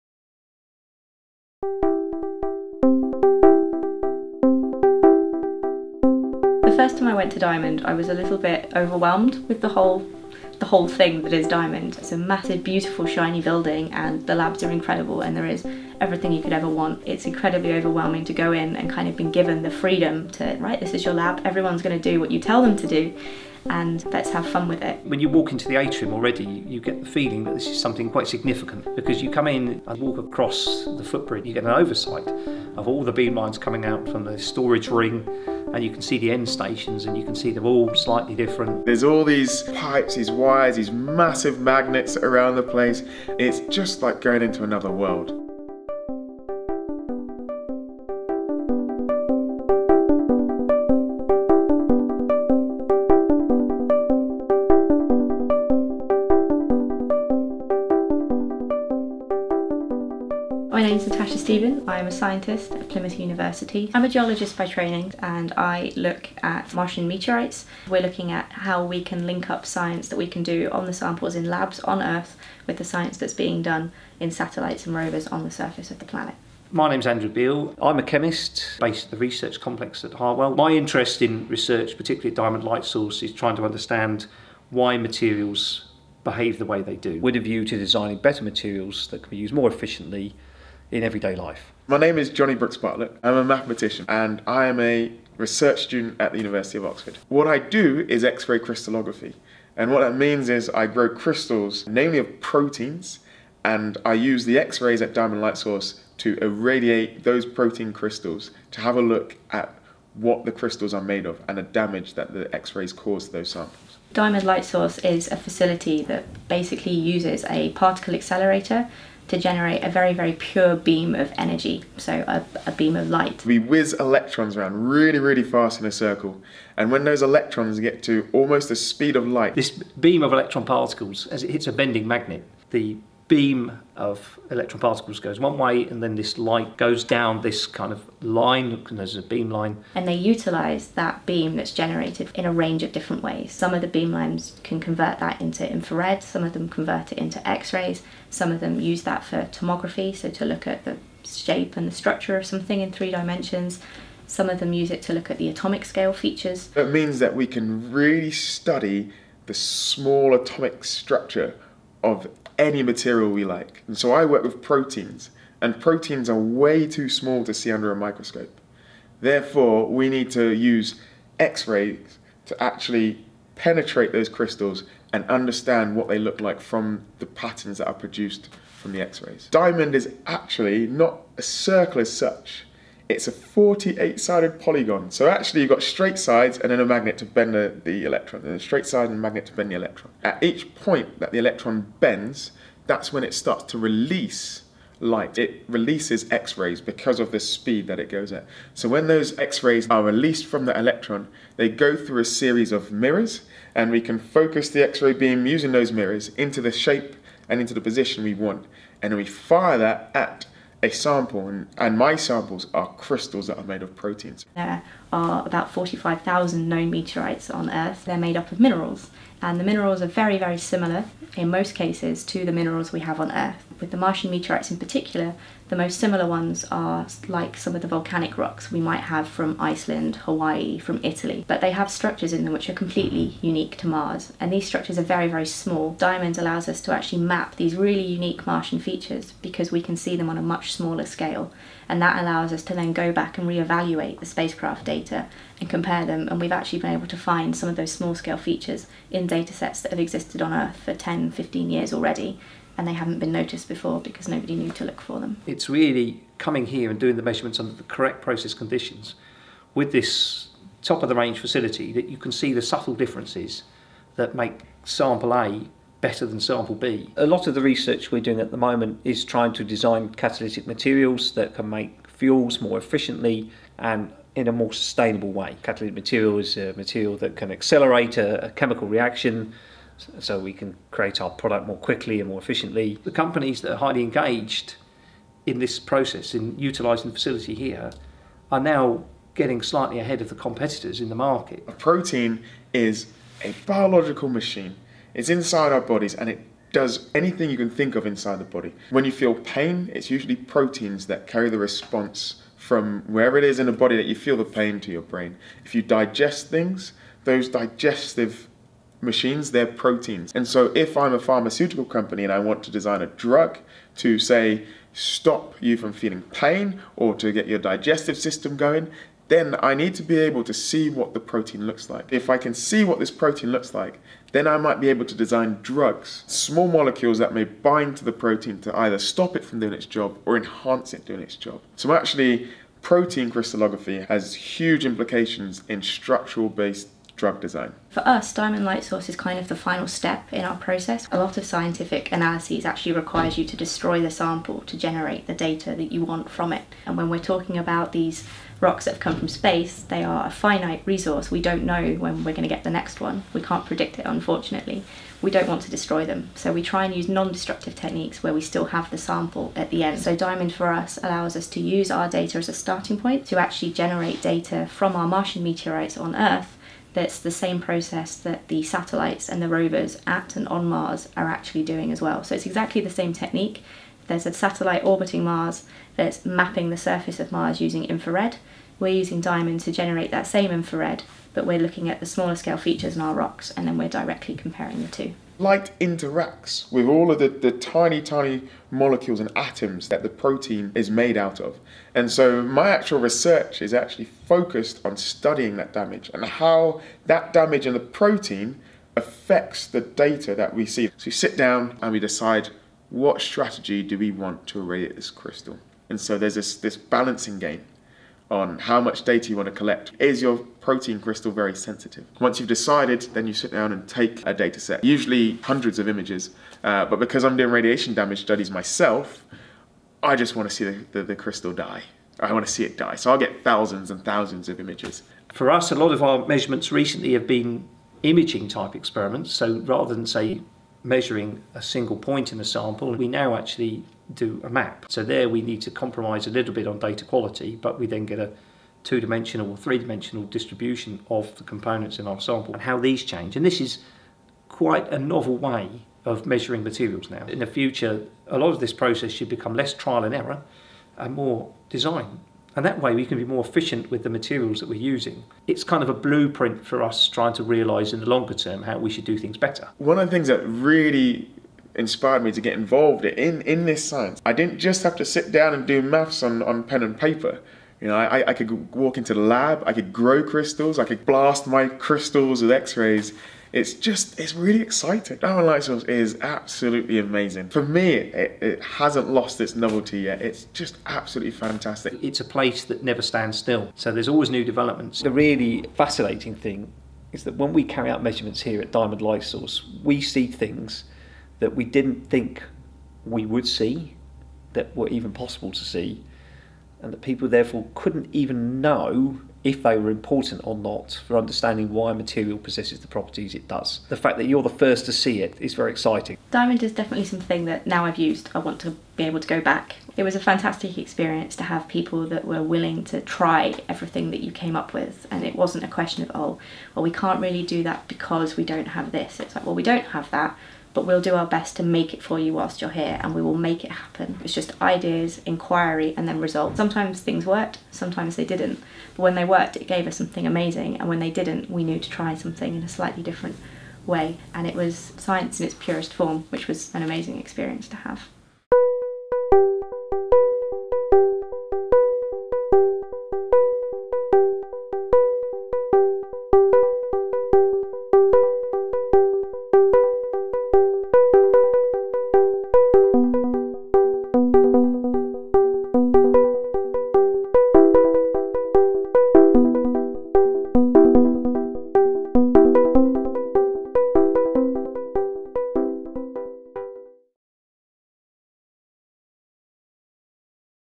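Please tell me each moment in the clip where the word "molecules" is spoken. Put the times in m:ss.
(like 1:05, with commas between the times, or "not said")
5:26, 6:28.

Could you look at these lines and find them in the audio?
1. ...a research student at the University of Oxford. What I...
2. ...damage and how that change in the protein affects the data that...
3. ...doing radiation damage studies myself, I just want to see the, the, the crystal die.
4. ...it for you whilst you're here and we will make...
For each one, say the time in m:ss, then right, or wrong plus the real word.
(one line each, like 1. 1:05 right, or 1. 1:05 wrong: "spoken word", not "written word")
1. 1:34 right
2. 6:35 wrong: "damage", not "change"
3. 6:57 right
4. 8:41 right.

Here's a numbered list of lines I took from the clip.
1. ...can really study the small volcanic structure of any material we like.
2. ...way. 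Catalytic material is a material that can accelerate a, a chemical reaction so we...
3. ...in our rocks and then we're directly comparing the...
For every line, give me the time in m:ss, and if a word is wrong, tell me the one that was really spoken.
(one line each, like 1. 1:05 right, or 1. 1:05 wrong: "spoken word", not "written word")
1. 2:37 wrong: "atomic", not "volcanic"
2. 4:35 right
3. 6:22 right.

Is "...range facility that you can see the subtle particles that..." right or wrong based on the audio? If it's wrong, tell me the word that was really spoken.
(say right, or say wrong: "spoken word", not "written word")
wrong: "differences", not "particles".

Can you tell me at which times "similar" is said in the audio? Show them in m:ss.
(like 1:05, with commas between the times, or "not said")
3:40, 3:45.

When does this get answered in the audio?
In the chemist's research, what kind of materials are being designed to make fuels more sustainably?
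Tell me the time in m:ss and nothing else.
4:30.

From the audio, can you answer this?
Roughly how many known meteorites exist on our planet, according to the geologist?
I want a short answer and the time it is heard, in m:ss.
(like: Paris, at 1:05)
45,000, at 3:35.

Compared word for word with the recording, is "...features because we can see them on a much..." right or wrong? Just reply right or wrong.
right.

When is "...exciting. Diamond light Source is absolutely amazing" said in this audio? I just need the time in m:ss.
7:54.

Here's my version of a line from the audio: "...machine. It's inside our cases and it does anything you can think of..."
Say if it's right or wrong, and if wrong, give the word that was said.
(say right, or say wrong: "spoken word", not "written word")
wrong: "bodies", not "cases".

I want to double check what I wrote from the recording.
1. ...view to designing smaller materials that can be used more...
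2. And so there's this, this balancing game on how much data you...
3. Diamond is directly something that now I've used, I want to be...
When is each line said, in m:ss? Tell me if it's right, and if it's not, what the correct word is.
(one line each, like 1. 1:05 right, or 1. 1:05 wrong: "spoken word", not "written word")
1. 1:27 wrong: "better", not "smaller"
2. 6:45 right
3. 8:26 wrong: "definitely", not "directly".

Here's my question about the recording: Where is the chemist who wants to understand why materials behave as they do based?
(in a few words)
Harwell.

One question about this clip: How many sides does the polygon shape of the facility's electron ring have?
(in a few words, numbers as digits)
48.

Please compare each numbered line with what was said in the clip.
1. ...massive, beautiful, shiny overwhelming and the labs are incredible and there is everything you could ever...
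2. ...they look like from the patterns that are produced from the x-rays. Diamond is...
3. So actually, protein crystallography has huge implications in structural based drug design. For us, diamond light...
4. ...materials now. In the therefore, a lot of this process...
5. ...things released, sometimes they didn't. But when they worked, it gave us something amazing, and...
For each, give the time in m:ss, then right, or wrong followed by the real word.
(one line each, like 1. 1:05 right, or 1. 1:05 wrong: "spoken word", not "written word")
1. 0:12 wrong: "building", not "overwhelming"
2. 2:56 right
3. 5:31 right
4. 7:26 wrong: "future", not "therefore"
5. 8:47 wrong: "worked", not "released".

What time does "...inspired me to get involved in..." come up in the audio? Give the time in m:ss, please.
7:41.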